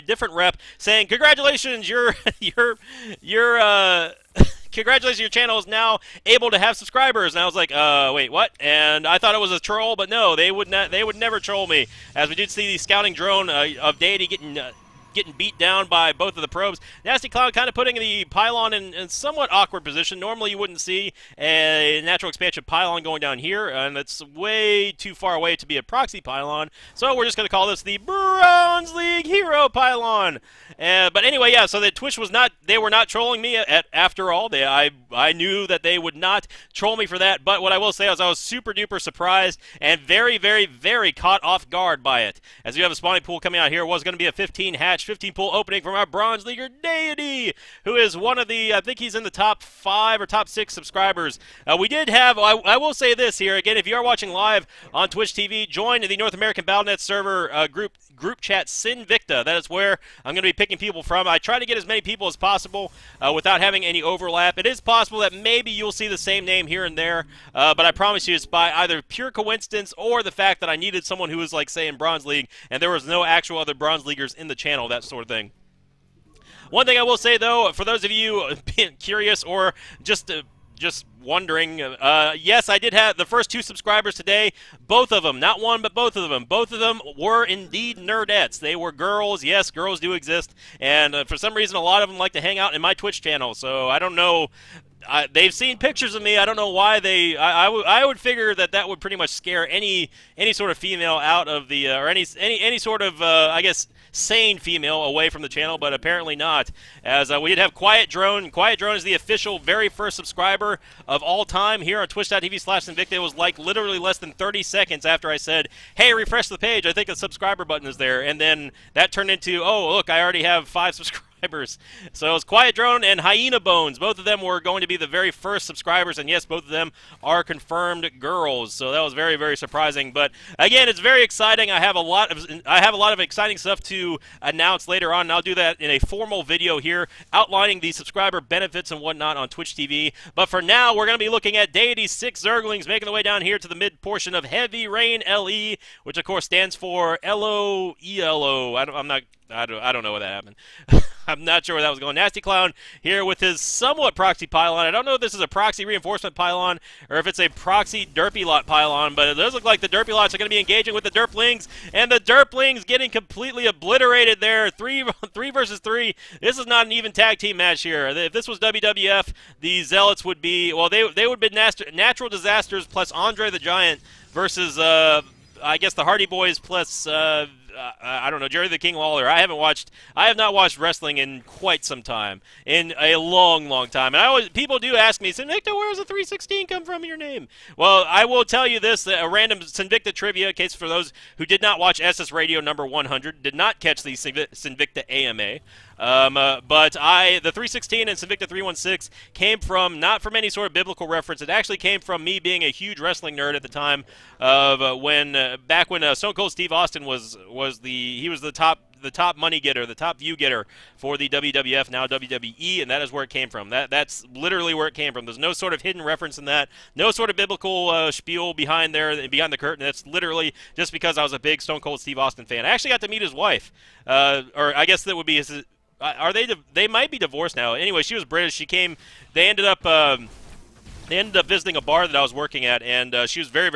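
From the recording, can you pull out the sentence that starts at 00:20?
Normally you wouldn't see a natural expansion pylon going down here, and it's way too far away to be a proxy pylon.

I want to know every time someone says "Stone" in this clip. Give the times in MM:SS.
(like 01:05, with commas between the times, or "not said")
03:26, 03:41.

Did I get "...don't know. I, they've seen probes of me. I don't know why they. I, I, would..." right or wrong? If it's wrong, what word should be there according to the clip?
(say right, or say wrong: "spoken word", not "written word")
wrong: "pictures", not "probes".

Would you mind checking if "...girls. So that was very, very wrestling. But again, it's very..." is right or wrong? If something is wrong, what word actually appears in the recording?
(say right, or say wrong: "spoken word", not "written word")
wrong: "surprising", not "wrestling".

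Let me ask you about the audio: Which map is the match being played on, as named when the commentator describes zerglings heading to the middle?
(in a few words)
Heavy Rain LE.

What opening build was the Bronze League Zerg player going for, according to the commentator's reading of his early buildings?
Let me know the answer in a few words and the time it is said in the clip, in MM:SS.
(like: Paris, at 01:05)
15 hatch 15 pool, at 00:44.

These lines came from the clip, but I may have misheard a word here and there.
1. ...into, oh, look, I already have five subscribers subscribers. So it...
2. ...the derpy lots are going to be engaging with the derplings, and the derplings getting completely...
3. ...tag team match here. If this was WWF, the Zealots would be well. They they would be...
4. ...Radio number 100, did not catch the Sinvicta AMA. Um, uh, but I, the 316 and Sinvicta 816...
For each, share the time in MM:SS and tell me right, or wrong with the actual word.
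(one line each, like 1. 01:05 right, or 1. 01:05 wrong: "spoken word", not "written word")
1. 01:59 right
2. 02:39 right
3. 02:47 right
4. 03:12 wrong: "316", not "816".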